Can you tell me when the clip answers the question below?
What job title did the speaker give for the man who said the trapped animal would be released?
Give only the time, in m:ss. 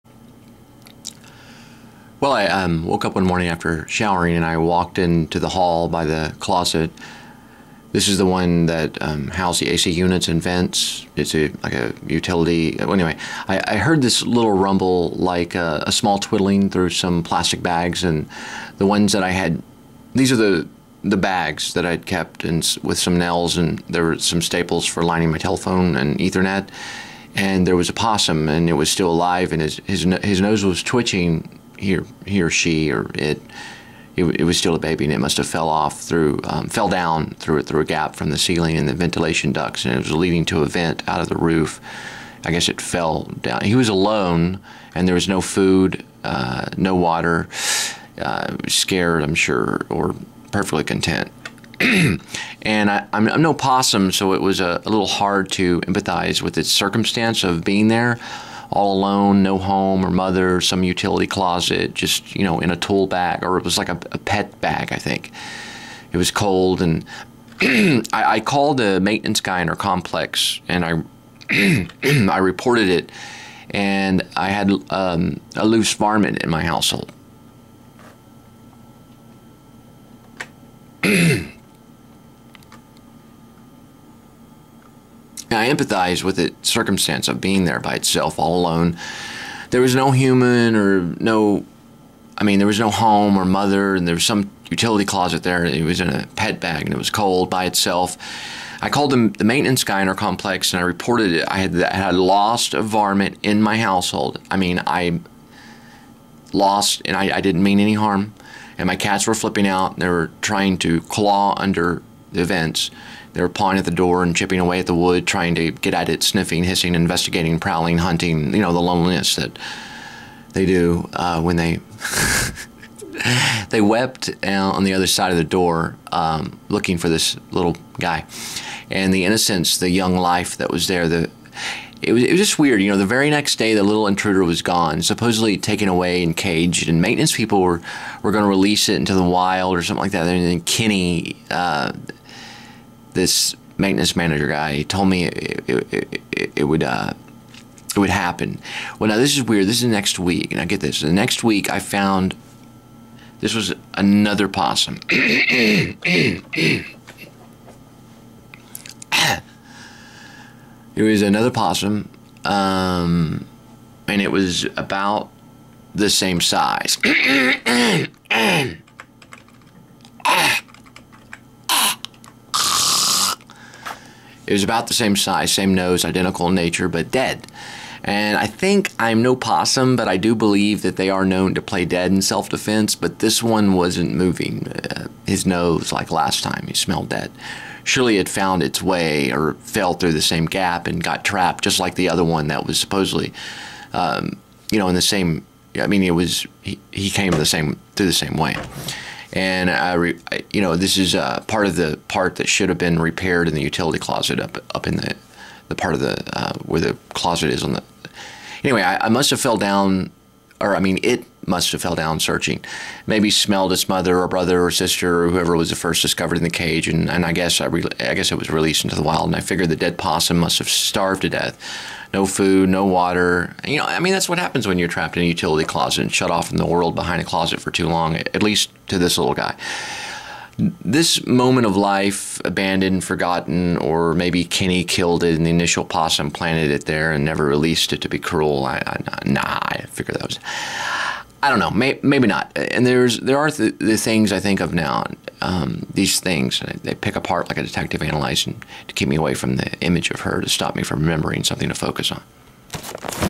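2:23.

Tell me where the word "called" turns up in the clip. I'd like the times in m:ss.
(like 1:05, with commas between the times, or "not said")
1:08, 1:38.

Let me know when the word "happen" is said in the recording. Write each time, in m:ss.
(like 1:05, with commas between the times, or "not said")
2:28, 3:44.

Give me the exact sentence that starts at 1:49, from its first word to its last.
And they were trying to claw under the events.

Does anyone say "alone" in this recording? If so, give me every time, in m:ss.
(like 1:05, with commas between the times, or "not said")
0:43, 0:58, 1:28.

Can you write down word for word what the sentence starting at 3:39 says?
And I figured the dead possum must have starved to death, no food, no water.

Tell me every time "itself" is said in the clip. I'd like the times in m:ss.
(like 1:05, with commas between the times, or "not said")
1:27, 1:37.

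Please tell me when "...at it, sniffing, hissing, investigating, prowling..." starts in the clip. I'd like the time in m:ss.
1:55.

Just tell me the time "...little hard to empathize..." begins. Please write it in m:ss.
0:54.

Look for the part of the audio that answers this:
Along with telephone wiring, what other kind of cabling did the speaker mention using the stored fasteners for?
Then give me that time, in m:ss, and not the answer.
0:26.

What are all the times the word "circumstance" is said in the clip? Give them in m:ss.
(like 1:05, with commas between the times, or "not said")
0:56, 1:26.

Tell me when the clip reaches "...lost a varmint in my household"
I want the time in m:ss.
1:42.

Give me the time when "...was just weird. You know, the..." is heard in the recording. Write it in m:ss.
2:12.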